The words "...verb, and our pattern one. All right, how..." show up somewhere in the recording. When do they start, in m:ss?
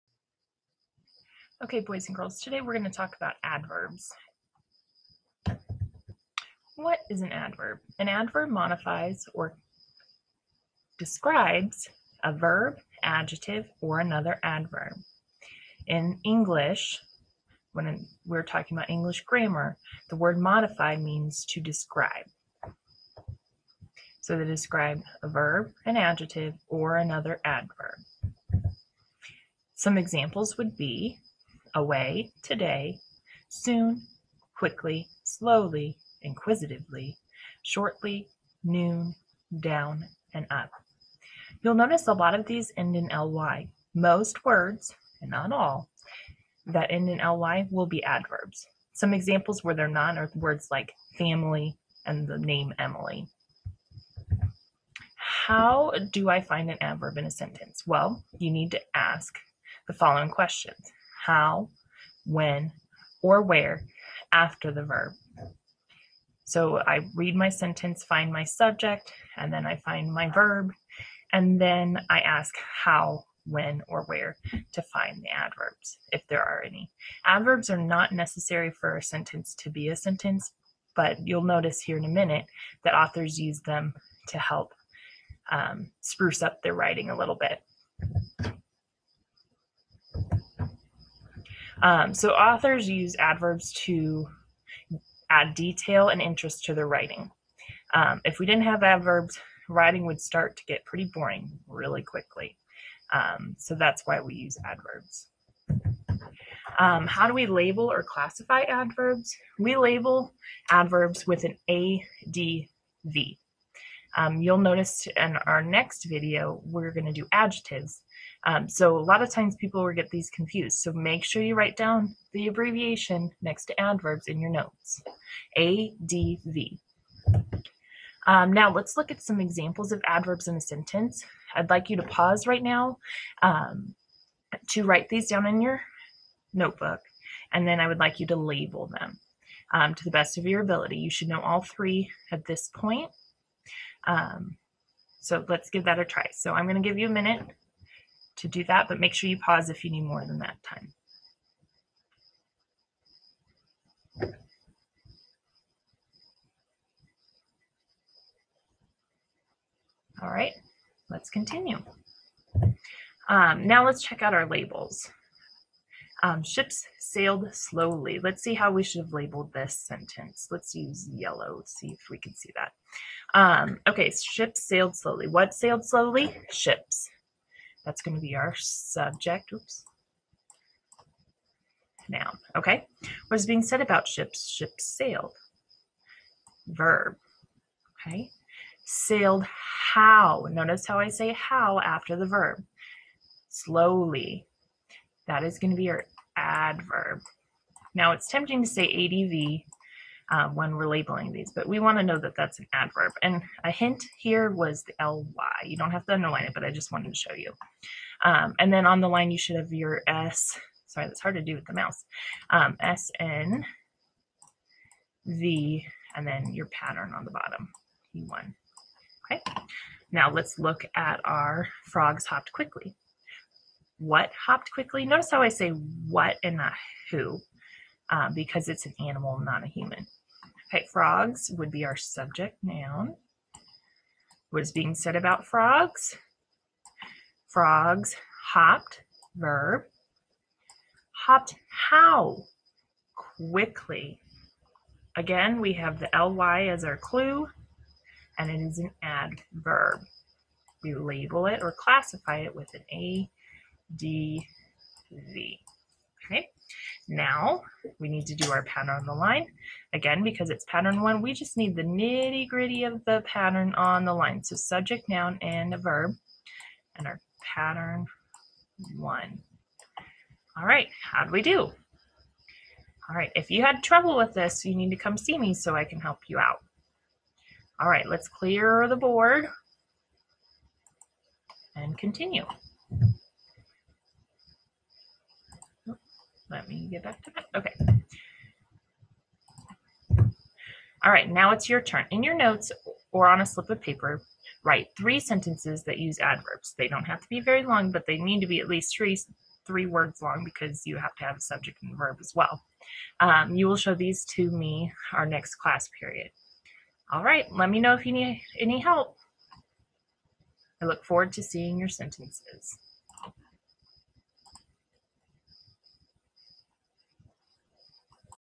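4:25.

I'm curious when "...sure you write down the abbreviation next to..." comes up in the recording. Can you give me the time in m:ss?
2:01.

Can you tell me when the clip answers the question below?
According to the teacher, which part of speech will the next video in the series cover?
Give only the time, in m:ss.
1:57.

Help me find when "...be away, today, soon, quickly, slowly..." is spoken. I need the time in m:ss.
0:30.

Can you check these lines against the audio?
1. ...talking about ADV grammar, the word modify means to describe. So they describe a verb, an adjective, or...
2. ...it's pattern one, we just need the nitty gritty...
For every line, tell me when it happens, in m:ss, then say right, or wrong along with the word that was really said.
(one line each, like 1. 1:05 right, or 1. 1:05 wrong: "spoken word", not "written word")
1. 0:18 wrong: "English", not "ADV"
2. 4:20 right.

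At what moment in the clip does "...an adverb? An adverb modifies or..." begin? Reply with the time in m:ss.
0:07.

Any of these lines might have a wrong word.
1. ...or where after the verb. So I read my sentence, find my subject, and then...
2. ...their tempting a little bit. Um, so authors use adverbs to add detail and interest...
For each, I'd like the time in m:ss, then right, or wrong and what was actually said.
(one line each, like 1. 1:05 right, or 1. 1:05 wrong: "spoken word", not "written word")
1. 1:03 right
2. 1:26 wrong: "writing", not "tempting".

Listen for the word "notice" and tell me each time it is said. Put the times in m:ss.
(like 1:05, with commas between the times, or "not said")
0:41, 1:21, 1:54, 3:10, 3:45.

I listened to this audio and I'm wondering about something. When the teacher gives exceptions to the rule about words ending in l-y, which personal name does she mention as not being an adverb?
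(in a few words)
Emily.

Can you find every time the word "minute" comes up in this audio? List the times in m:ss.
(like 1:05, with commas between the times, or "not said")
1:22, 2:27.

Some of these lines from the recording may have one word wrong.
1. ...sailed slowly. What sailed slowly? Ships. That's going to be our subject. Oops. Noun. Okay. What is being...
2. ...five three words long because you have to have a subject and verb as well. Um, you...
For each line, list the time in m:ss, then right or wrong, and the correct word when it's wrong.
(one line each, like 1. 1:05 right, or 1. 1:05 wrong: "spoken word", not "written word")
1. 2:54 right
2. 4:58 wrong: "three", not "five".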